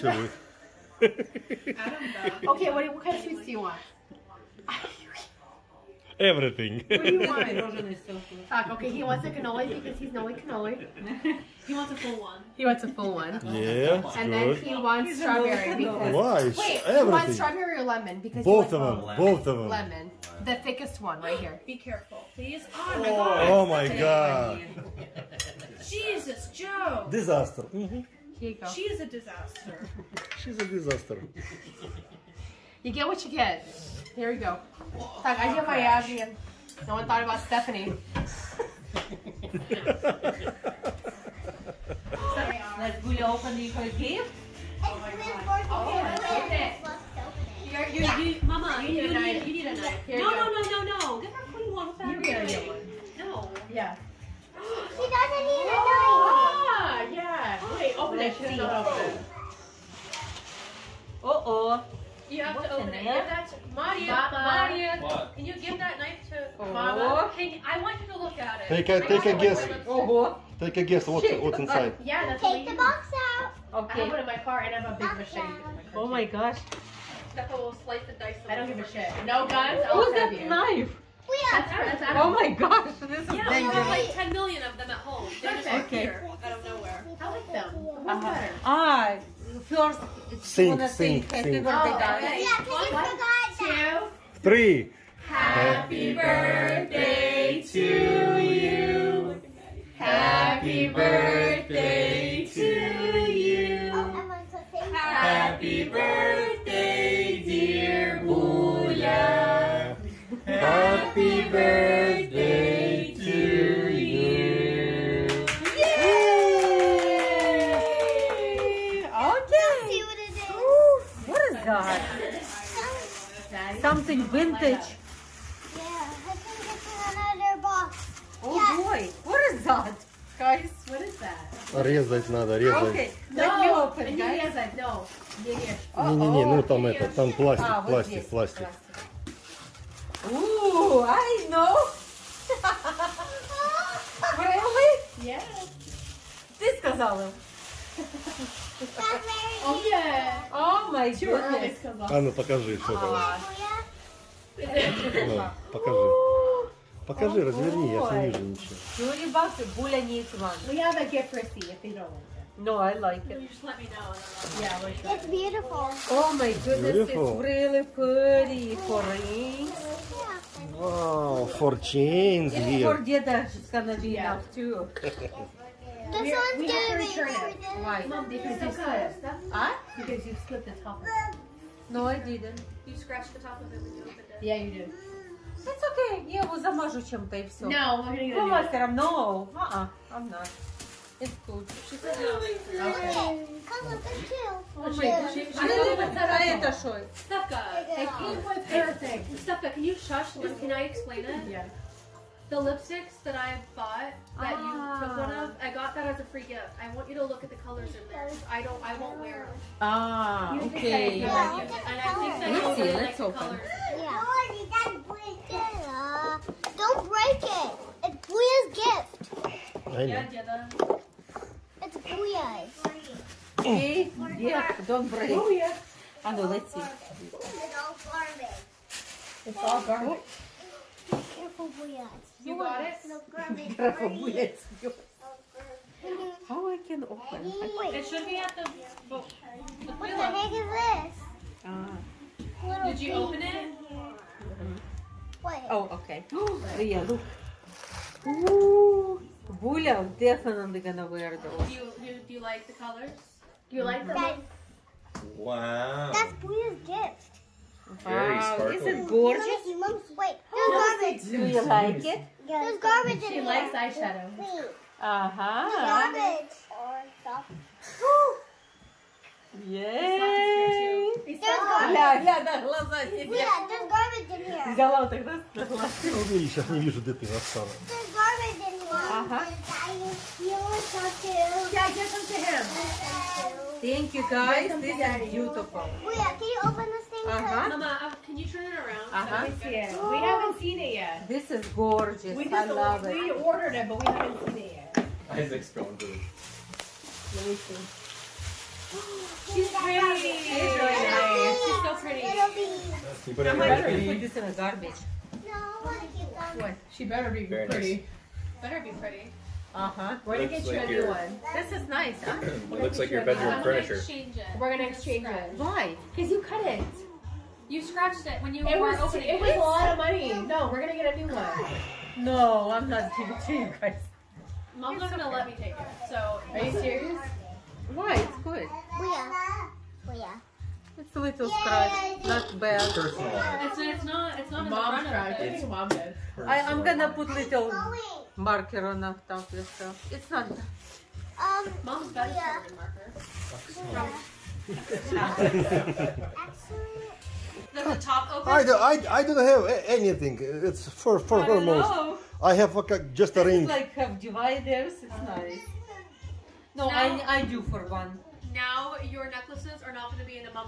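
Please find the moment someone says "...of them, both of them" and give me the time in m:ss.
0:18.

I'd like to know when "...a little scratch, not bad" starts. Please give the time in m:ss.
5:31.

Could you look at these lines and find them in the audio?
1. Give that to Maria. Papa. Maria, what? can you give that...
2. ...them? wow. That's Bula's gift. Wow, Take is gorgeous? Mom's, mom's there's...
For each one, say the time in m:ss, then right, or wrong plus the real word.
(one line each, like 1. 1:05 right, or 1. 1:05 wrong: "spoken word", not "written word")
1. 1:03 right
2. 4:14 wrong: "This", not "Take".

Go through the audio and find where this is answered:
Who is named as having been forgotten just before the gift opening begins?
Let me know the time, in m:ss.
0:36.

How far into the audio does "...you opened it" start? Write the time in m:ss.
3:03.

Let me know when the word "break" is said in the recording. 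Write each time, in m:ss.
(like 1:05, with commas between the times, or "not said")
3:37, 3:45.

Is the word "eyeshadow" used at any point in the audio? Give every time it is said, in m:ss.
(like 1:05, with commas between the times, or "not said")
4:23.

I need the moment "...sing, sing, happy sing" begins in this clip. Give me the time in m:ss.
1:30.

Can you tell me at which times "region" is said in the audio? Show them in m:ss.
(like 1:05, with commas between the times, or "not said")
not said.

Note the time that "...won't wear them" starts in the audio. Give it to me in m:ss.
3:28.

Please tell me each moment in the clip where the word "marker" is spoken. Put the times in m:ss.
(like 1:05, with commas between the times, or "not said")
5:38, 5:42.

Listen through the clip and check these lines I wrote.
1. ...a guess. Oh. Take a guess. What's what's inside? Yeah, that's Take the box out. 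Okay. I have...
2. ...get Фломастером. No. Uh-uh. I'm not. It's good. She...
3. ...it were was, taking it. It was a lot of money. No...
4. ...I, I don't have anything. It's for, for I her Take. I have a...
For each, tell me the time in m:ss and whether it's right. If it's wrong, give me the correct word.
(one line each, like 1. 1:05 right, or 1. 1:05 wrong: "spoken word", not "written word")
1. 1:09 right
2. 3:08 right
3. 5:18 wrong: "opening", not "taking"
4. 5:48 wrong: "Know", not "Take".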